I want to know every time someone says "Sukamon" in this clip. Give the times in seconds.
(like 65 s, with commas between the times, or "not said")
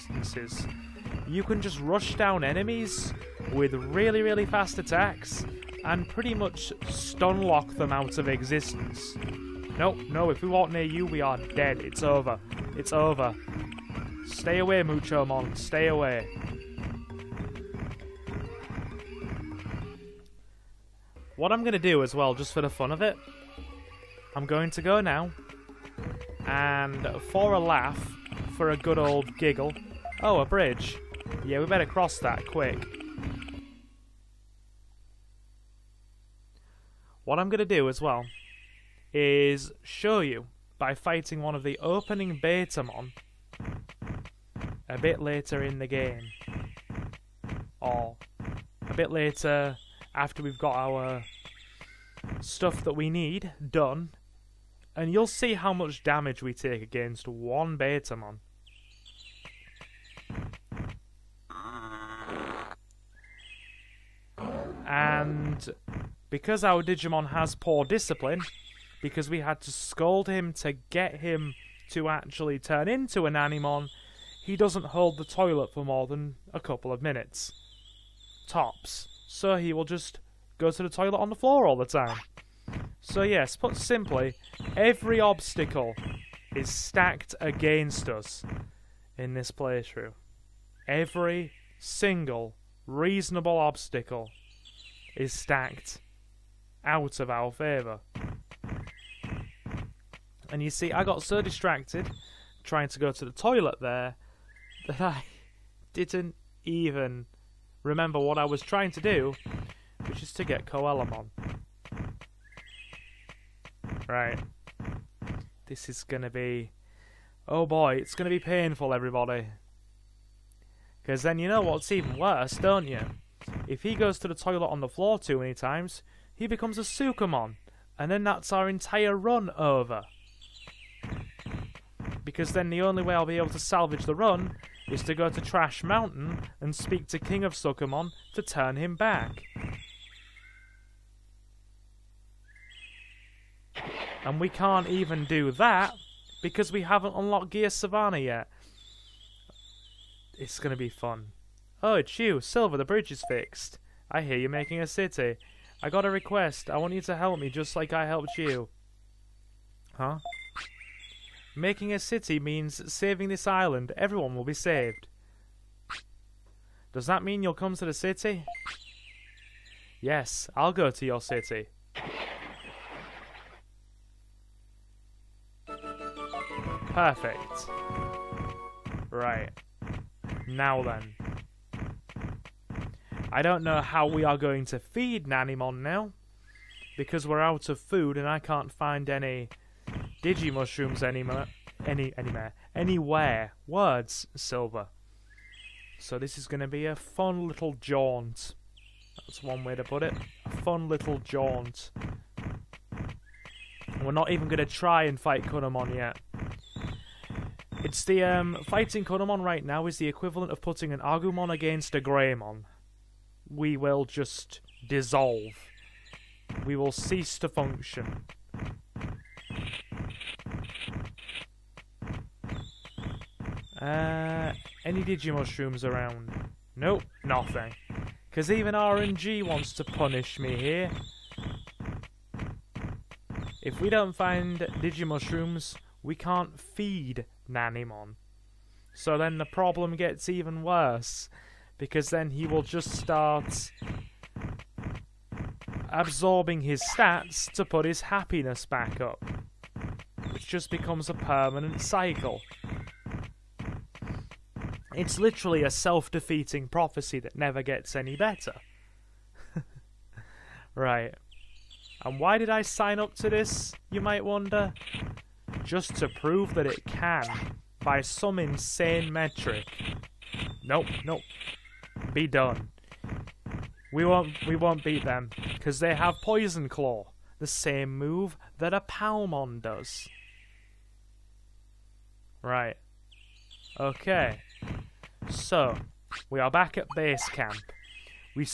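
126 s, 137 s.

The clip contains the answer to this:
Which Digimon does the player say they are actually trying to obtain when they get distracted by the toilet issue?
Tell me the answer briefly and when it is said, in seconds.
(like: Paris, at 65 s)
Coelamon, at 110 s.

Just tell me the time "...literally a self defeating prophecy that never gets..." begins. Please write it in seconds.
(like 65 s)
255 s.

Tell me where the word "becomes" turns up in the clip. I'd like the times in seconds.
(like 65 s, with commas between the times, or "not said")
126 s, 250 s.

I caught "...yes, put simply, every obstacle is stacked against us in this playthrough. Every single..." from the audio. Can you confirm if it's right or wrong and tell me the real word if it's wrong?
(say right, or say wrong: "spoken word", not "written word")
right.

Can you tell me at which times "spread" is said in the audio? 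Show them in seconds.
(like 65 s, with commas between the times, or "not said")
not said.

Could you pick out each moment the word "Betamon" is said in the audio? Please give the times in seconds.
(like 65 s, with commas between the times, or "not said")
42 s, 57 s.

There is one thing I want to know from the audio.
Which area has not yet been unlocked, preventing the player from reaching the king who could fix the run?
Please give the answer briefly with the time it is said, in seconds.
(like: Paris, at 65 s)
Gear Savanna, at 147 s.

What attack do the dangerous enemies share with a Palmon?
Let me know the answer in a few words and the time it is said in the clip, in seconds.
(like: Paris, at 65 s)
Poison Claw, at 276 s.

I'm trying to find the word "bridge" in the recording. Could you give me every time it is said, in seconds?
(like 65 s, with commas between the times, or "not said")
30 s, 152 s.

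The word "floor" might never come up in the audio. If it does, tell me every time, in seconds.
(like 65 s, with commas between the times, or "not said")
81 s, 124 s.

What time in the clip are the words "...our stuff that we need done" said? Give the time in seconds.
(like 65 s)
50 s.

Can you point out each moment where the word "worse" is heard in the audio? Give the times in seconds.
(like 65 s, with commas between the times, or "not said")
122 s, 240 s.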